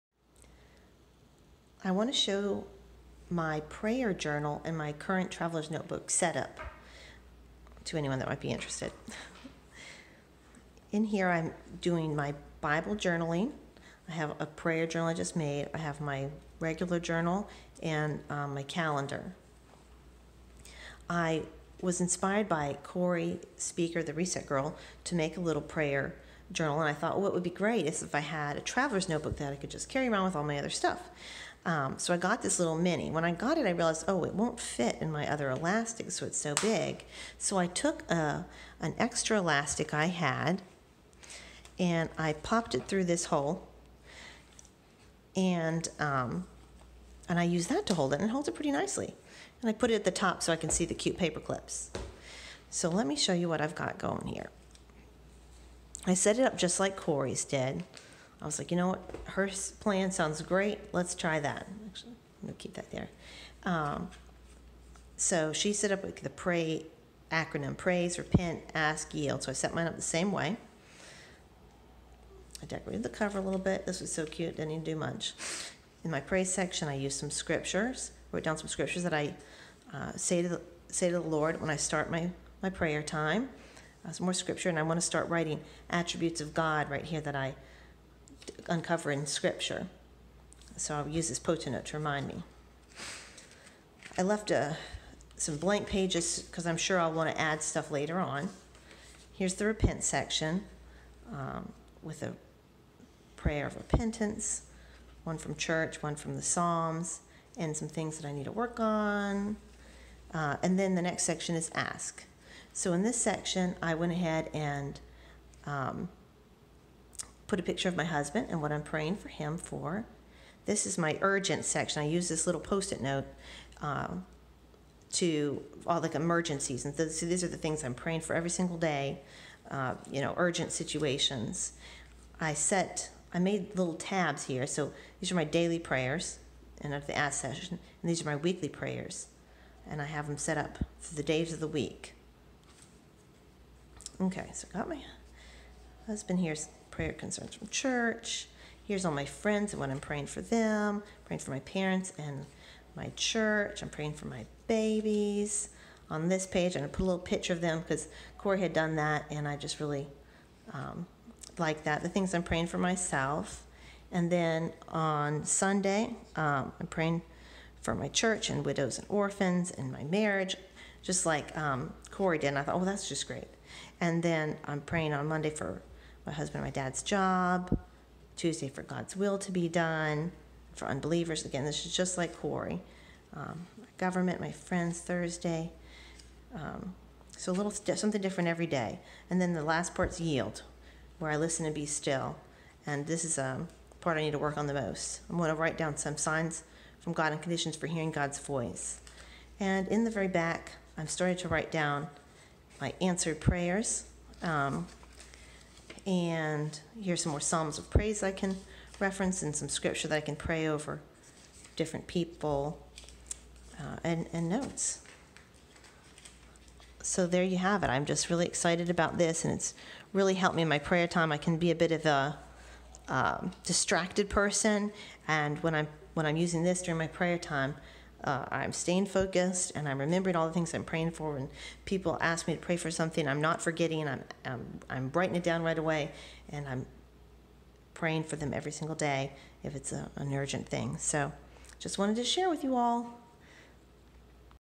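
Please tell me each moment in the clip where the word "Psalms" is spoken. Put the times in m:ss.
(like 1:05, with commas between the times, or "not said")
1:46, 3:27.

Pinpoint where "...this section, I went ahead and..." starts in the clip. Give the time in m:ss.
1:53.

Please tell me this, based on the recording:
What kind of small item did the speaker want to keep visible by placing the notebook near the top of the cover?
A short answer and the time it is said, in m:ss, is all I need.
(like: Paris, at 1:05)
paper clips, at 0:51.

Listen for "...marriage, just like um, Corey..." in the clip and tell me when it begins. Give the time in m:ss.
2:50.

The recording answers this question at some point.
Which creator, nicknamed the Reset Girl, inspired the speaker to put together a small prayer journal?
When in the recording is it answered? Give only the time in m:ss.
0:22.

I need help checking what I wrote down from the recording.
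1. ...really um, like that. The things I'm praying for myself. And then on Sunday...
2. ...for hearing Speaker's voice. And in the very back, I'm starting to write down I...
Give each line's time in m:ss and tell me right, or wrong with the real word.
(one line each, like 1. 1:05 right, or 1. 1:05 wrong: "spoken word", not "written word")
1. 2:39 right
2. 3:17 wrong: "God", not "Speaker".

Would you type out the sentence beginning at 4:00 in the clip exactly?
So just wanted to share with you all.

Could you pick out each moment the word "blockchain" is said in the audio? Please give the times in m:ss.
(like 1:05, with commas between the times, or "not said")
not said.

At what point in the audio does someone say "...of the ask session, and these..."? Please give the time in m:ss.
2:16.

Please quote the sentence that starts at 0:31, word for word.
Um, so I got this little mini.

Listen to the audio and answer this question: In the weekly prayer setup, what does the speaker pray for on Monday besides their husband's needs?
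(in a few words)
dad's job.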